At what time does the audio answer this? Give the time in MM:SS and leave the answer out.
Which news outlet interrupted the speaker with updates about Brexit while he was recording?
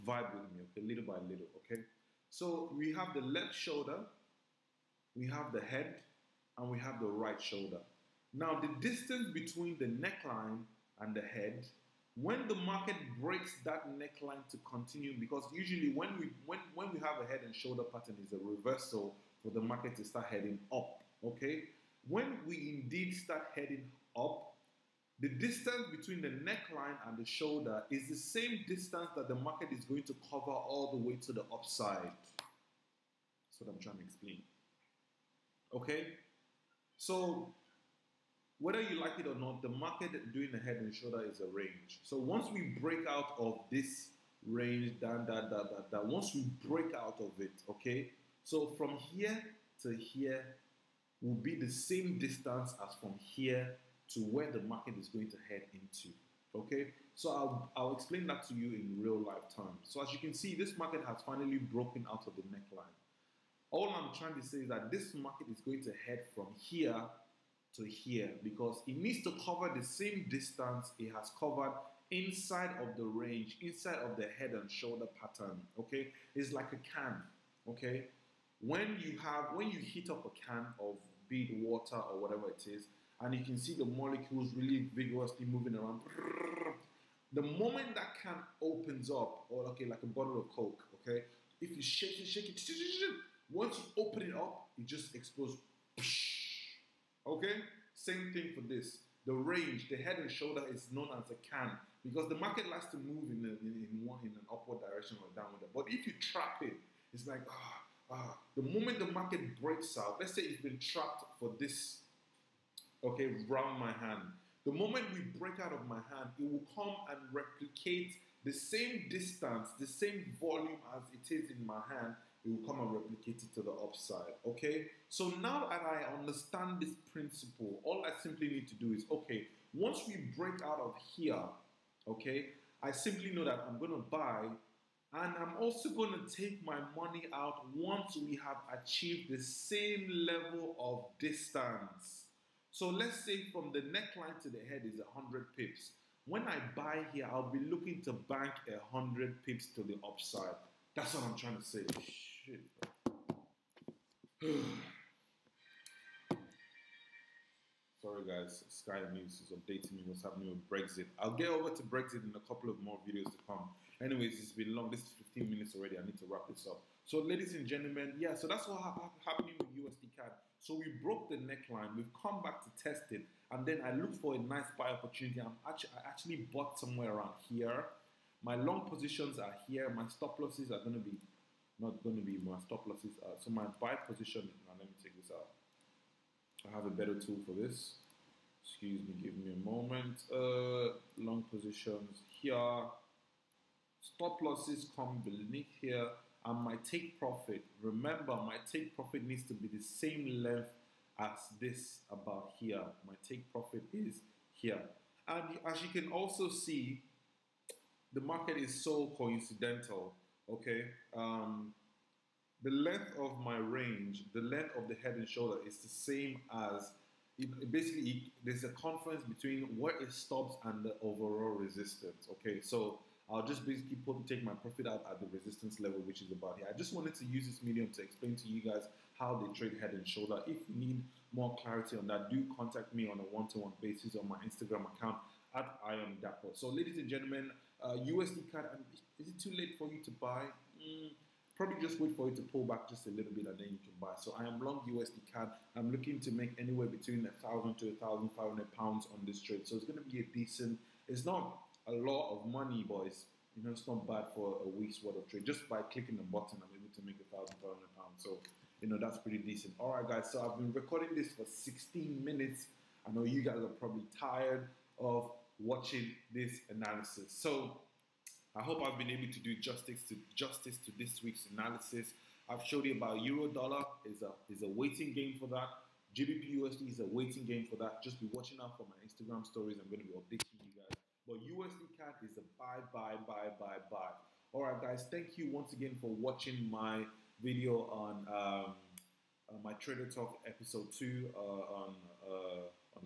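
02:38.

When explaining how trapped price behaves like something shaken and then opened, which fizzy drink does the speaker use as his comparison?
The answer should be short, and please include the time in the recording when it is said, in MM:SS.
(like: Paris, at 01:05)
Coke, at 01:30.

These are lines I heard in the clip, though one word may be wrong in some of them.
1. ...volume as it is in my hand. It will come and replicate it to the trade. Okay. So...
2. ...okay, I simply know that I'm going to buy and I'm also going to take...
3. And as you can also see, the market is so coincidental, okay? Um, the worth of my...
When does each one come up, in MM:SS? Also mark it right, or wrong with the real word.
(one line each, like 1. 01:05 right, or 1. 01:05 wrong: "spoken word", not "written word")
1. 02:00 wrong: "upside", not "trade"
2. 02:12 right
3. 03:25 wrong: "length", not "worth".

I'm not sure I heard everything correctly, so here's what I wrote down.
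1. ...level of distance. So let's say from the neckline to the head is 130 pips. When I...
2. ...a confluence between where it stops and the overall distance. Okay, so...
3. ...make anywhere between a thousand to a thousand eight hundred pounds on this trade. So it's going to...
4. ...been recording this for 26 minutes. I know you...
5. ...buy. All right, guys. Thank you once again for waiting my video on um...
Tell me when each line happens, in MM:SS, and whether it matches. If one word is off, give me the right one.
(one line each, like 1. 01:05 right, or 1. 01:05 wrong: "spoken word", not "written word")
1. 02:20 wrong: "100", not "130"
2. 03:38 wrong: "resistance", not "distance"
3. 04:06 wrong: "five", not "eight"
4. 04:20 wrong: "16", not "26"
5. 04:43 wrong: "watching", not "waiting".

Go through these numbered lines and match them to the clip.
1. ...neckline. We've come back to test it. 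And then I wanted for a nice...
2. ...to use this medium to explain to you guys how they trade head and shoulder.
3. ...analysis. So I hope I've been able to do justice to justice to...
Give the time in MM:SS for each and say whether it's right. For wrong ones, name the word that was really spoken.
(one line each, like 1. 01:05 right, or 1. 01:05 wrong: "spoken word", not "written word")
1. 02:51 wrong: "looked", not "wanted"
2. 03:47 right
3. 04:26 right.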